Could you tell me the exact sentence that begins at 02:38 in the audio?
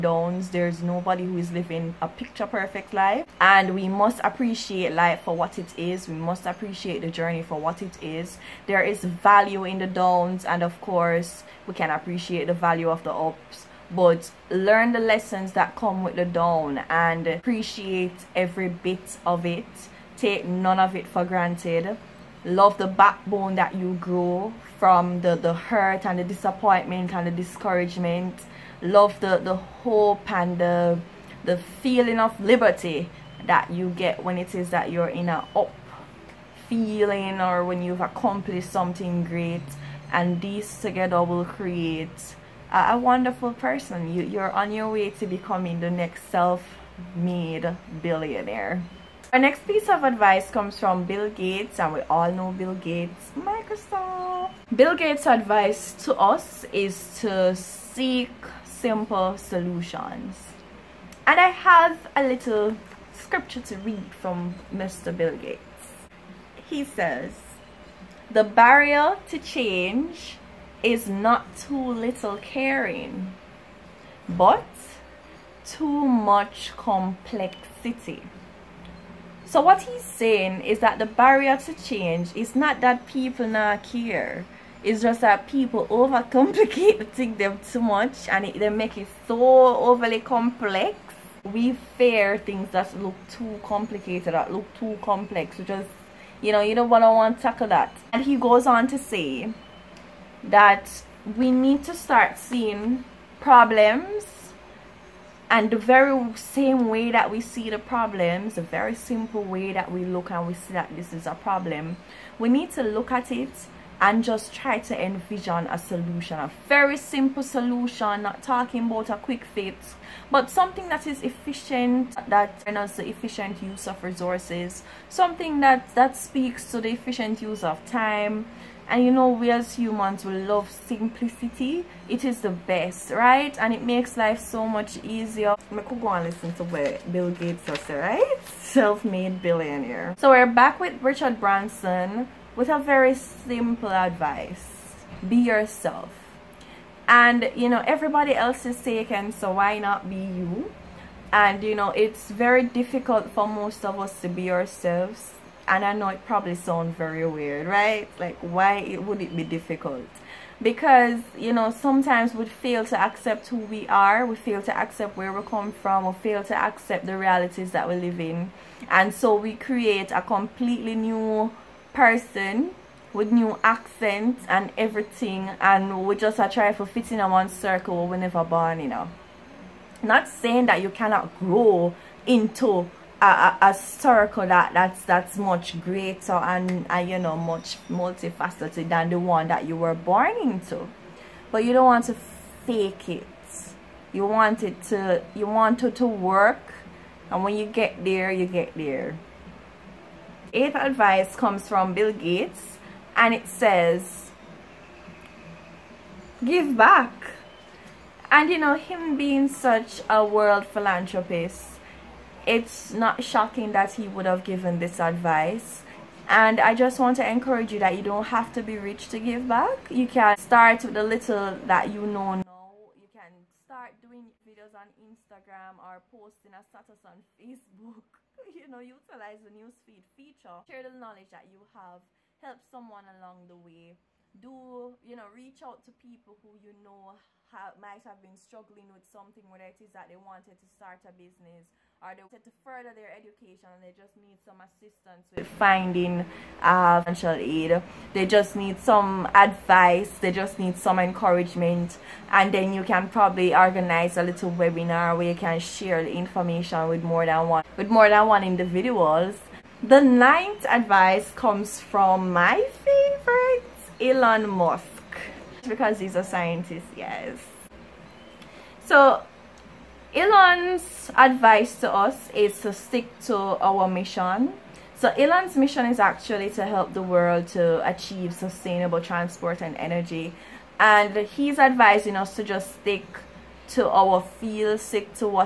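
Like, why it, would it be difficult?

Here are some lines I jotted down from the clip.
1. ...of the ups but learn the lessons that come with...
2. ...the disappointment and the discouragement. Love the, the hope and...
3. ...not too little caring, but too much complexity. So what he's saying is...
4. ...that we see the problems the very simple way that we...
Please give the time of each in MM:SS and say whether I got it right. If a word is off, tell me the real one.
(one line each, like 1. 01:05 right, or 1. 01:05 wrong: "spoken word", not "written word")
1. 00:12 right
2. 00:26 right
3. 01:11 right
4. 01:47 right.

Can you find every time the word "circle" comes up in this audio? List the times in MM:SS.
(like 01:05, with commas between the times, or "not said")
02:57, 03:03.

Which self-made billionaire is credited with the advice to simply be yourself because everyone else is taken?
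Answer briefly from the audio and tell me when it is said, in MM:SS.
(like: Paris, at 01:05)
Richard Branson, at 02:21.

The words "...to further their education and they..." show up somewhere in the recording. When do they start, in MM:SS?
04:02.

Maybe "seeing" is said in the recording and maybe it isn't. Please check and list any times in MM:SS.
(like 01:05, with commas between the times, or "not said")
01:42.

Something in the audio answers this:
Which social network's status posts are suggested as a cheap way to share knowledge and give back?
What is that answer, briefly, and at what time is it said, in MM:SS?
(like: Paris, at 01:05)
Facebook, at 03:47.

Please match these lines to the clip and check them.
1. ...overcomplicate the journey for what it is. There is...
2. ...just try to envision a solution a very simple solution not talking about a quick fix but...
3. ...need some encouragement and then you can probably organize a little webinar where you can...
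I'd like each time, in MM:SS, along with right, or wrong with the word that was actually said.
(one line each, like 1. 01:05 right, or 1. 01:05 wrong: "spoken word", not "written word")
1. 00:06 wrong: "appreciate", not "overcomplicate"
2. 01:54 right
3. 04:10 right.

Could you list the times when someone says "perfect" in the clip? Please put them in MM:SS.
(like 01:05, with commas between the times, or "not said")
00:02.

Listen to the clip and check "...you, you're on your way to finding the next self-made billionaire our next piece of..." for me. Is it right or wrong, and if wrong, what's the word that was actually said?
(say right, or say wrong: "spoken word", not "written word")
wrong: "becoming", not "finding".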